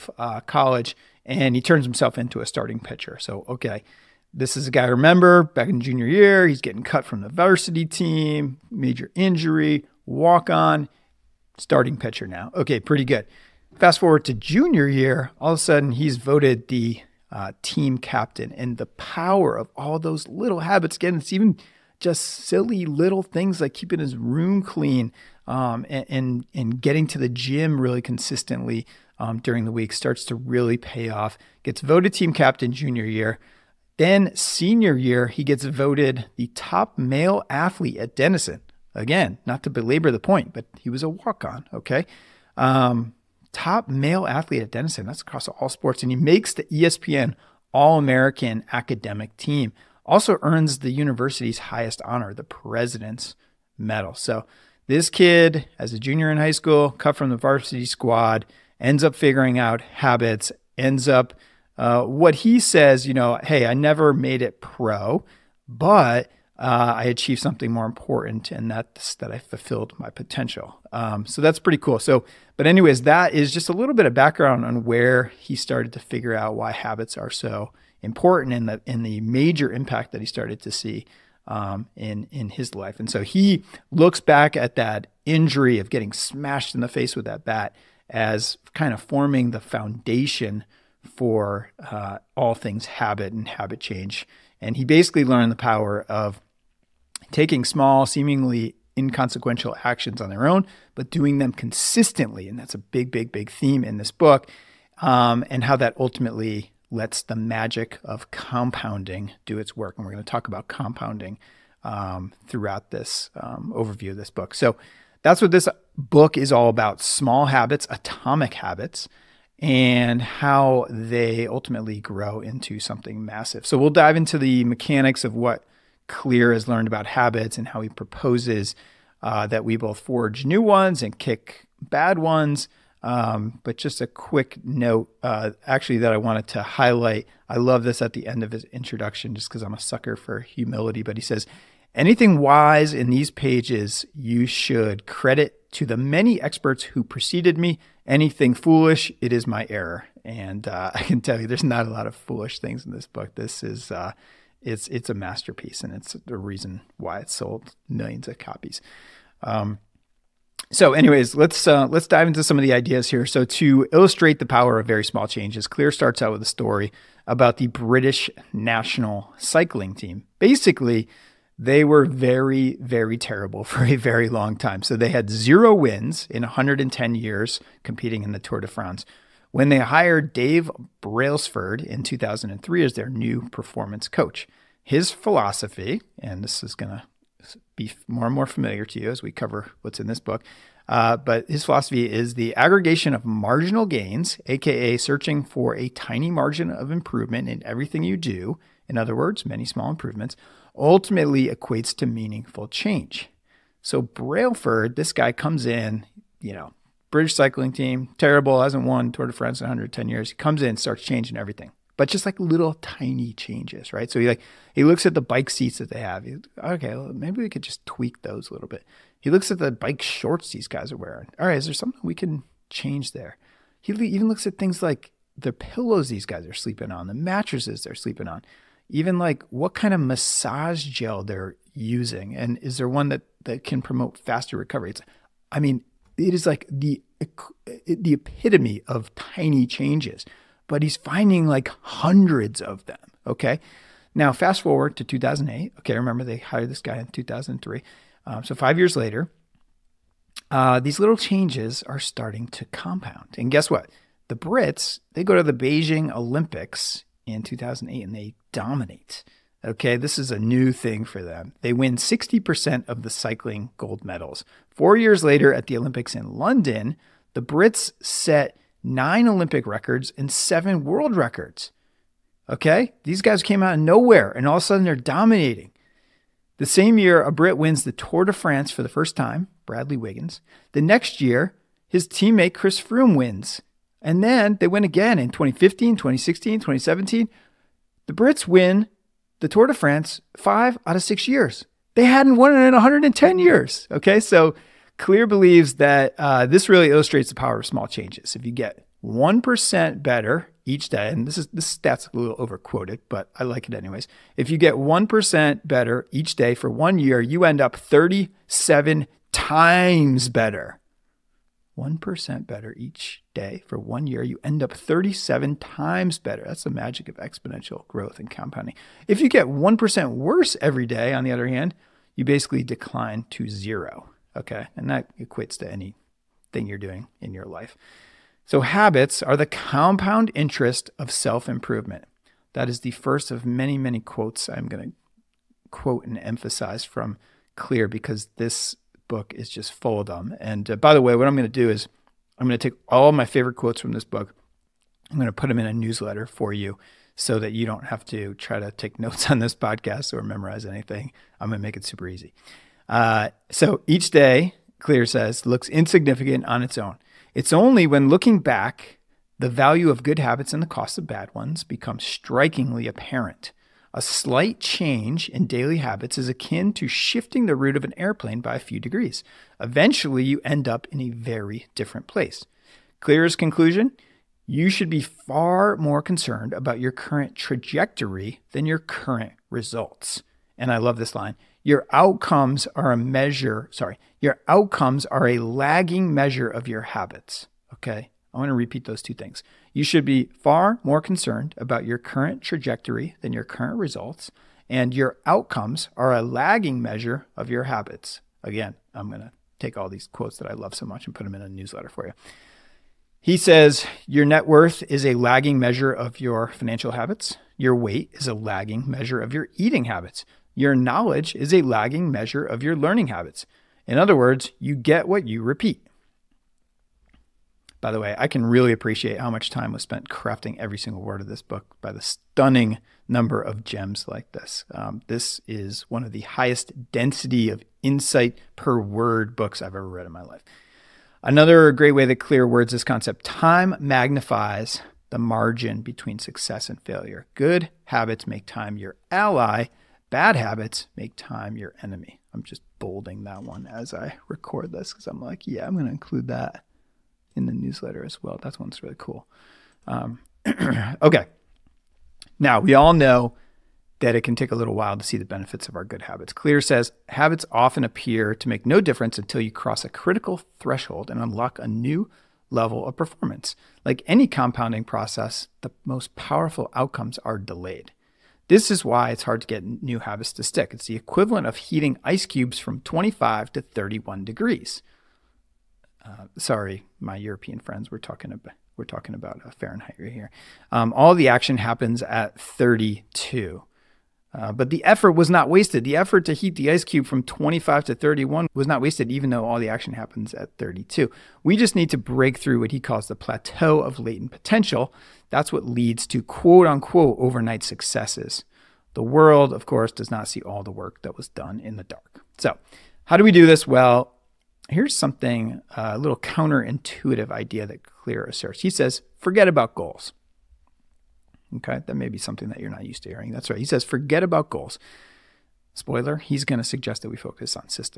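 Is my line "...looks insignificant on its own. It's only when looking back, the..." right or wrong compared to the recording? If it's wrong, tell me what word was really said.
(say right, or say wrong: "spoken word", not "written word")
right.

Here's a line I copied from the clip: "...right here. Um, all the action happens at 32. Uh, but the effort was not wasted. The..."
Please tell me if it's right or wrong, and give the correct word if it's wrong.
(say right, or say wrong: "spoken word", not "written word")
right.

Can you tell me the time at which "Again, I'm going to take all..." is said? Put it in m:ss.
6:38.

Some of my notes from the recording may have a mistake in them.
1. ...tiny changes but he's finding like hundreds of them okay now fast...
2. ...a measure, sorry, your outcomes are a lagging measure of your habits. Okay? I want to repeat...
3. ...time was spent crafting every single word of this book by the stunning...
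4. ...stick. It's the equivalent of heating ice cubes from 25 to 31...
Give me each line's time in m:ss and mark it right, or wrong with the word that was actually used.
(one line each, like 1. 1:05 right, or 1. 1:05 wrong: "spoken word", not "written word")
1. 3:59 right
2. 6:22 right
3. 6:59 right
4. 7:50 right.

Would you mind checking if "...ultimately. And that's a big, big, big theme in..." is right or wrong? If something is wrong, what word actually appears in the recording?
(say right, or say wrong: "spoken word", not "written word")
wrong: "consistently", not "ultimately".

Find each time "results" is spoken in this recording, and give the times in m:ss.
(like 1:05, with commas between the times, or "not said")
6:19, 6:33.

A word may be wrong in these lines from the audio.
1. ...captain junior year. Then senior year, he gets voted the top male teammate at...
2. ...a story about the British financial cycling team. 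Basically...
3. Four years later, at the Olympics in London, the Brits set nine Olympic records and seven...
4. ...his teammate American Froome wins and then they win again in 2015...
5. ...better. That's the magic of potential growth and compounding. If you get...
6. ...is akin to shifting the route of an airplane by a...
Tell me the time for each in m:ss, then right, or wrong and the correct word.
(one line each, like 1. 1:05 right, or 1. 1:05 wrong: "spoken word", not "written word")
1. 0:32 wrong: "athlete", not "teammate"
2. 2:46 wrong: "national", not "financial"
3. 4:24 right
4. 4:41 wrong: "Chris", not "American"
5. 5:16 wrong: "exponential", not "potential"
6. 6:06 right.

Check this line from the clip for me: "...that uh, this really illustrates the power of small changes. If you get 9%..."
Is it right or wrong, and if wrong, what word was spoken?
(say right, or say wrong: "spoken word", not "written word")
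wrong: "1", not "9".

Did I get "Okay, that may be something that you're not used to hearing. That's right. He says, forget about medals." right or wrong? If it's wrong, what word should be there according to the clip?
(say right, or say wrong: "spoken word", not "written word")
wrong: "goals", not "medals".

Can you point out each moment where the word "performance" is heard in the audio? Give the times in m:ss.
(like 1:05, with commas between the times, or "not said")
3:03, 7:42.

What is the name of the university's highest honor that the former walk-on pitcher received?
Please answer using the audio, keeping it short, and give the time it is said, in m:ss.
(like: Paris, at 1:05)
President's Medal, at 0:52.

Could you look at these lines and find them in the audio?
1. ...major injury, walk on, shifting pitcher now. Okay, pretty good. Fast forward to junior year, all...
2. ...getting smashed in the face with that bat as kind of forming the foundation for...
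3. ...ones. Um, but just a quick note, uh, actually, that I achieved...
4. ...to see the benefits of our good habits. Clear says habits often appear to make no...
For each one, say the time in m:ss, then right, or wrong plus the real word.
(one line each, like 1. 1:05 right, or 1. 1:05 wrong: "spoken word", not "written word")
1. 0:08 wrong: "starting", not "shifting"
2. 1:25 right
3. 2:12 wrong: "wanted", not "achieved"
4. 7:34 right.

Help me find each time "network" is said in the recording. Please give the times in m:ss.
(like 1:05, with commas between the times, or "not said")
not said.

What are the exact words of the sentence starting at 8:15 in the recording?
That's what leads to quote unquote overnight successes.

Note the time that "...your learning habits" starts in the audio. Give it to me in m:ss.
6:52.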